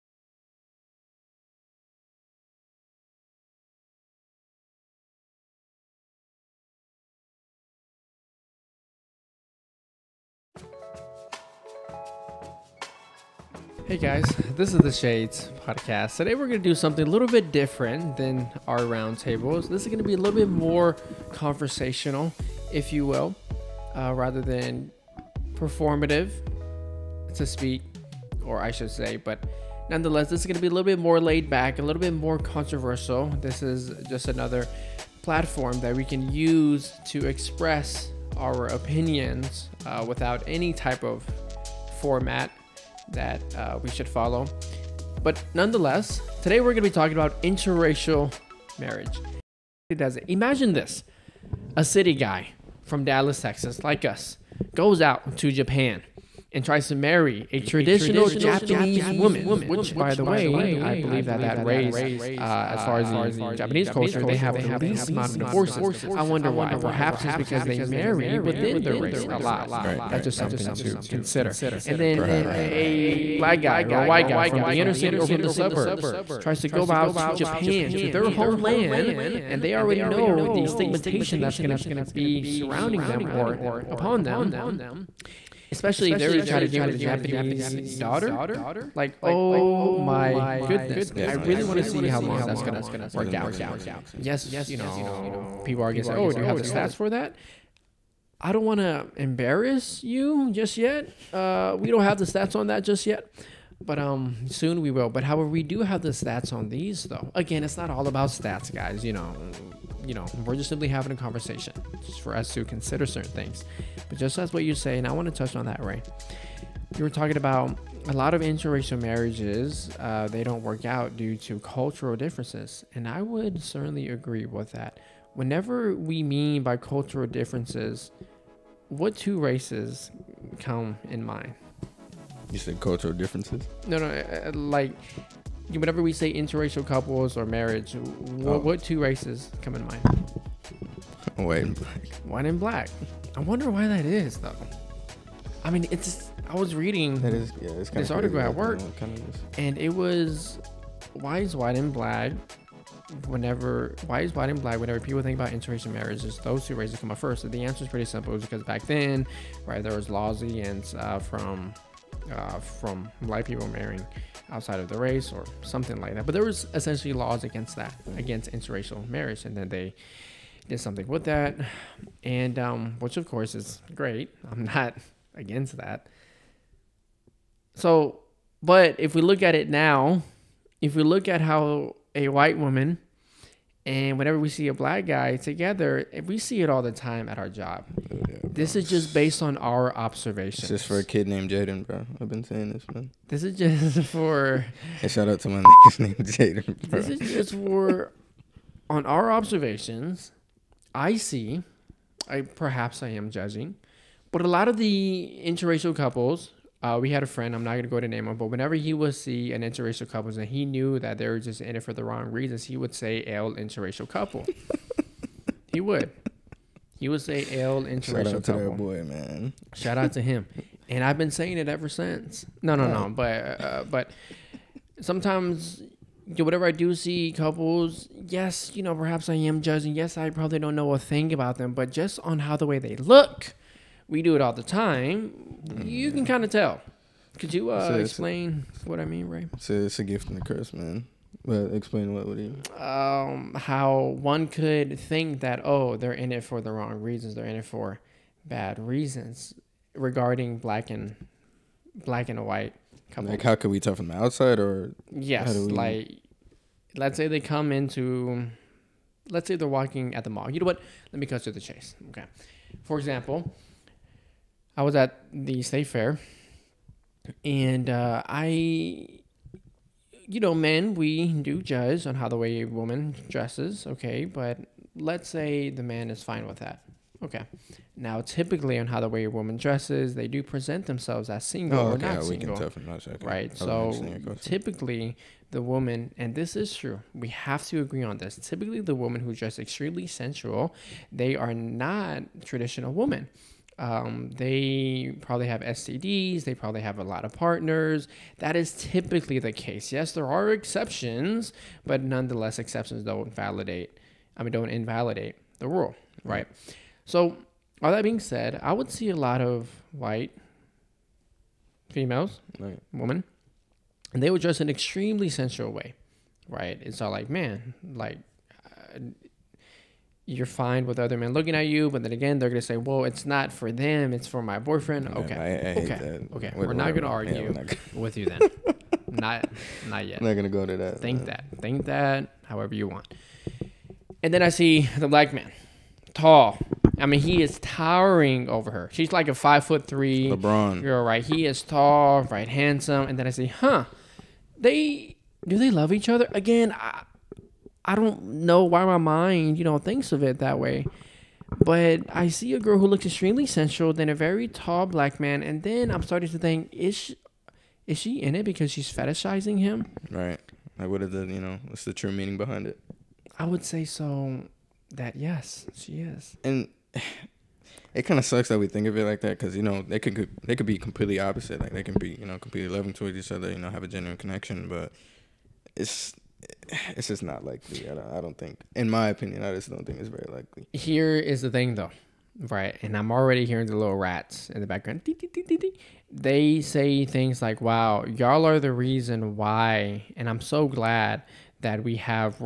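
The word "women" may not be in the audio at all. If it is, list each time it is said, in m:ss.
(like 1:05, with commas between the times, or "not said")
4:52, 5:12.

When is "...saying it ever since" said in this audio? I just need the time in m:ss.
3:41.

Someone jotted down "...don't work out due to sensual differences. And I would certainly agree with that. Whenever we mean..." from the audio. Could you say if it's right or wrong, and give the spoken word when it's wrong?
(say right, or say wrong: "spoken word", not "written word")
wrong: "cultural", not "sensual".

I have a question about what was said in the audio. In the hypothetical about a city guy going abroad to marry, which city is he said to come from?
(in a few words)
Dallas, Texas.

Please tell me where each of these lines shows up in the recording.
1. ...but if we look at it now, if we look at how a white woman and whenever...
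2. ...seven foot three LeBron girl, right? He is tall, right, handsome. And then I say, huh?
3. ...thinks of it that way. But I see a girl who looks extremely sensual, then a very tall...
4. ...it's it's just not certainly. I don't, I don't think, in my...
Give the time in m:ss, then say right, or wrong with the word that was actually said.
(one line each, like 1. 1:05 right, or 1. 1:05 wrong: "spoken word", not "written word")
1. 2:58 right
2. 5:39 wrong: "five", not "seven"
3. 5:49 right
4. 6:15 wrong: "likely", not "certainly".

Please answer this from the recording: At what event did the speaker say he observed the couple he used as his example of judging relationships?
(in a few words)
The state fair.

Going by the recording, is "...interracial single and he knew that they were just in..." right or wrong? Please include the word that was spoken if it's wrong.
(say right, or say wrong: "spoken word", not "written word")
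wrong: "couple", not "single".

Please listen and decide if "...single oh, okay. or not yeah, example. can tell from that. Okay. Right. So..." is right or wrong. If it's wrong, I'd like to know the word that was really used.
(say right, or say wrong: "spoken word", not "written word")
wrong: "single", not "example".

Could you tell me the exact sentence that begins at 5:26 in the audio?
We're, we're, not gonna argue yeah, not gonna...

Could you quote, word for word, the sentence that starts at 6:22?
And I'm already hearing the little rats in the background.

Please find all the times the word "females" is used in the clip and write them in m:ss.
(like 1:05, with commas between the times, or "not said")
5:11.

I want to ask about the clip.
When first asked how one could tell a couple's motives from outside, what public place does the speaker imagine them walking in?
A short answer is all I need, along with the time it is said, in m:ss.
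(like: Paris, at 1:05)
The mall, at 4:20.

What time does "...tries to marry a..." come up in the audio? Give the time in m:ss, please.
0:56.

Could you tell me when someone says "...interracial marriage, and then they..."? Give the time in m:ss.
2:48.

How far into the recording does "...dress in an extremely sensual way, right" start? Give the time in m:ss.
5:14.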